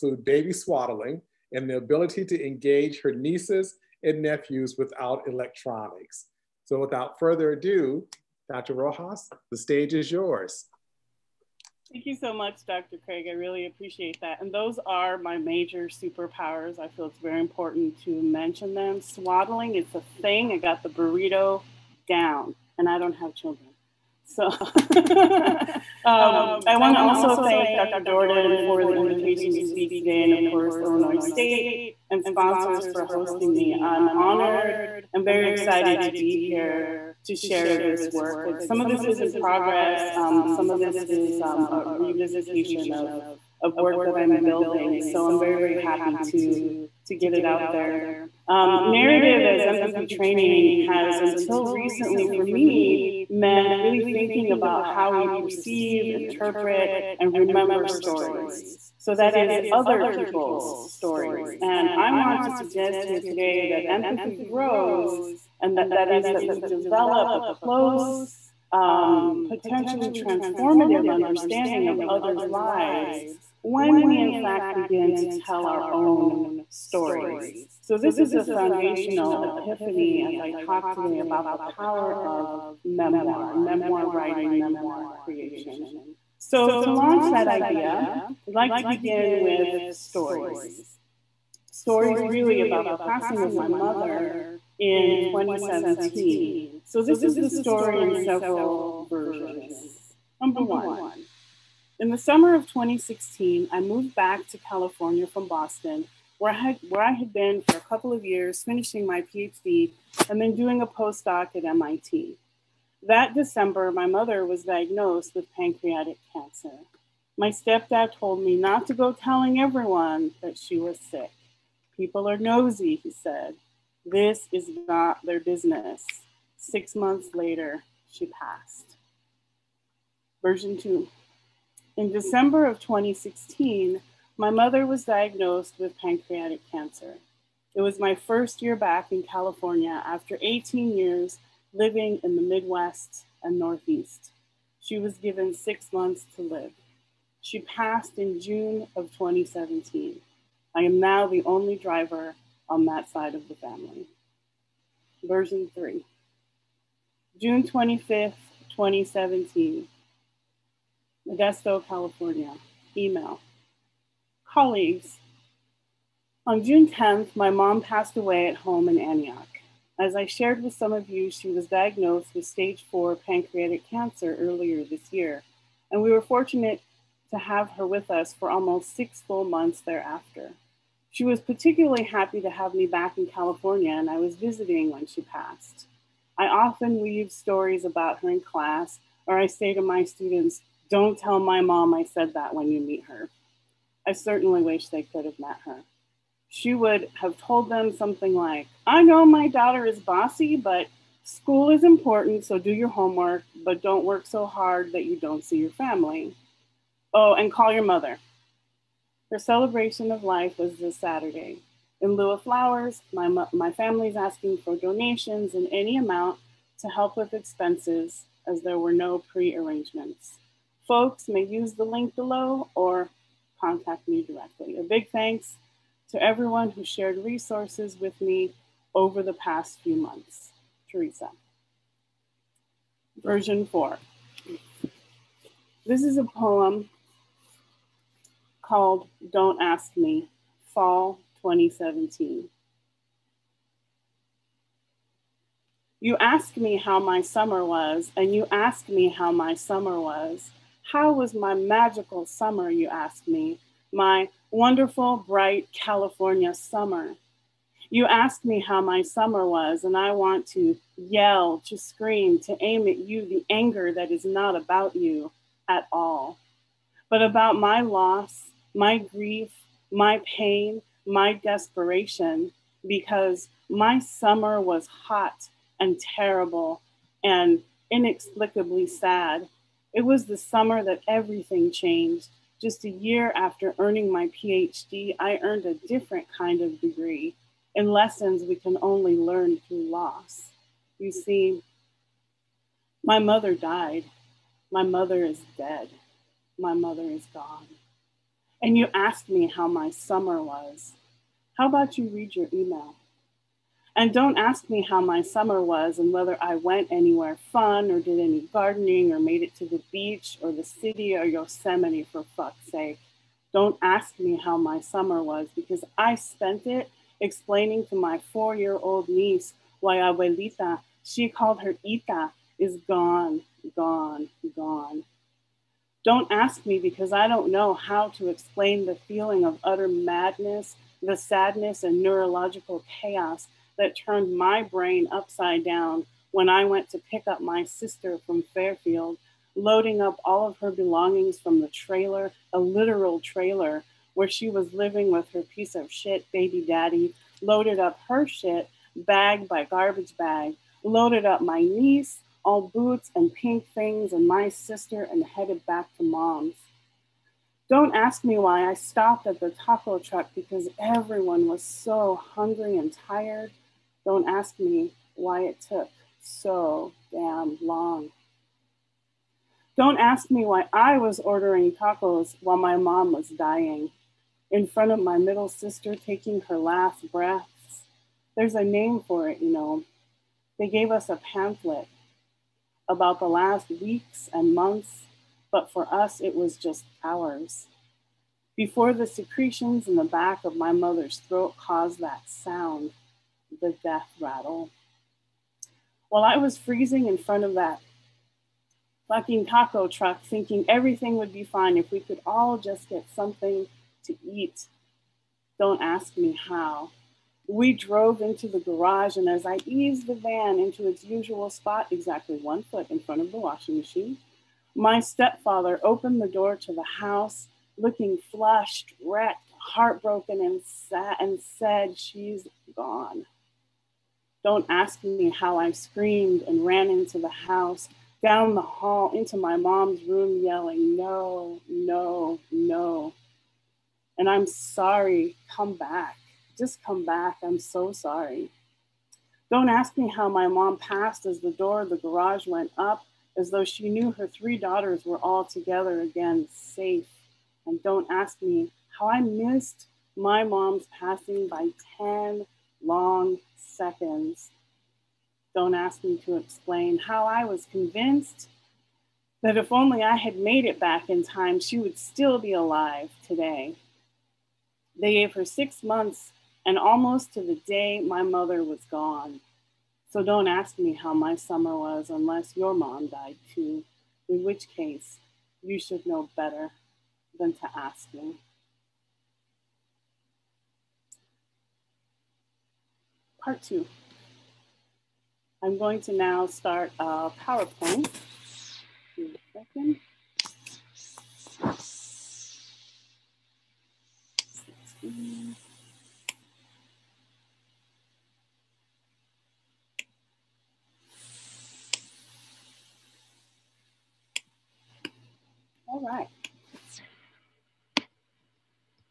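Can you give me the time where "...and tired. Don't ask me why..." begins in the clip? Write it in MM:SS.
06:02.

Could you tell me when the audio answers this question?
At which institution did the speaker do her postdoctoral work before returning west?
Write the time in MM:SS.
01:51.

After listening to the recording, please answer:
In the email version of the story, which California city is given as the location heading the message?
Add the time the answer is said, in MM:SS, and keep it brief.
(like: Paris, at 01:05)
Modesto, at 02:41.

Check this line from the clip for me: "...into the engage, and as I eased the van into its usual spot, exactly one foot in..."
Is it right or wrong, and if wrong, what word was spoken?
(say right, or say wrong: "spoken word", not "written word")
wrong: "garage", not "engage".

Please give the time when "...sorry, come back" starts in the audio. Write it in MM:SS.
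07:14.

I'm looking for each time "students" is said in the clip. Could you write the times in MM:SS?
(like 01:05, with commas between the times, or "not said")
03:10.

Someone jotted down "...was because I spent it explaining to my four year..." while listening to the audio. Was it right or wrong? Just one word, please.
right.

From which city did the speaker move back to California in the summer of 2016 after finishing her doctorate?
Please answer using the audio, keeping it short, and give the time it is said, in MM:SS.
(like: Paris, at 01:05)
Boston, at 01:45.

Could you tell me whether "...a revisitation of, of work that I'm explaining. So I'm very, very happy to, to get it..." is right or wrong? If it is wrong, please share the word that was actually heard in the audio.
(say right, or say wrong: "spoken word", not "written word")
wrong: "building", not "explaining".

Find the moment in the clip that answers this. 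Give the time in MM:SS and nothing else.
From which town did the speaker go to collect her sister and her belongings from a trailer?
05:38.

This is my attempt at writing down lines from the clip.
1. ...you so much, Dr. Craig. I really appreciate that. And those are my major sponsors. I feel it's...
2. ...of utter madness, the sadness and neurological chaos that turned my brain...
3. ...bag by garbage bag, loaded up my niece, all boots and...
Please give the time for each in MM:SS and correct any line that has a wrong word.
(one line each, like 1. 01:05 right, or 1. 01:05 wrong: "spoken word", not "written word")
1. 00:12 wrong: "superpowers", not "sponsors"
2. 05:29 right
3. 05:48 right.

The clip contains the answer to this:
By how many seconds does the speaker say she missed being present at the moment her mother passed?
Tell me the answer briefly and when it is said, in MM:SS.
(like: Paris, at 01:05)
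10, at 07:31.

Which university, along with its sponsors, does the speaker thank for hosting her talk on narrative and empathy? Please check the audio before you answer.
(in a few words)
Illinois State.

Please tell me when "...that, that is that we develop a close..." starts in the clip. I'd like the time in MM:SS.
01:05.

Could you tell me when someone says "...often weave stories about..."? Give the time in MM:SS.
03:06.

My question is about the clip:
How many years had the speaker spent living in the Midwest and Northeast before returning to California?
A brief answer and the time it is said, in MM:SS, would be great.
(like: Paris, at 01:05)
18, at 02:20.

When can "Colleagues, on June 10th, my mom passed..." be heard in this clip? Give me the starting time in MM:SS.
02:44.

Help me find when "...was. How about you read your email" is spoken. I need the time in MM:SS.
05:00.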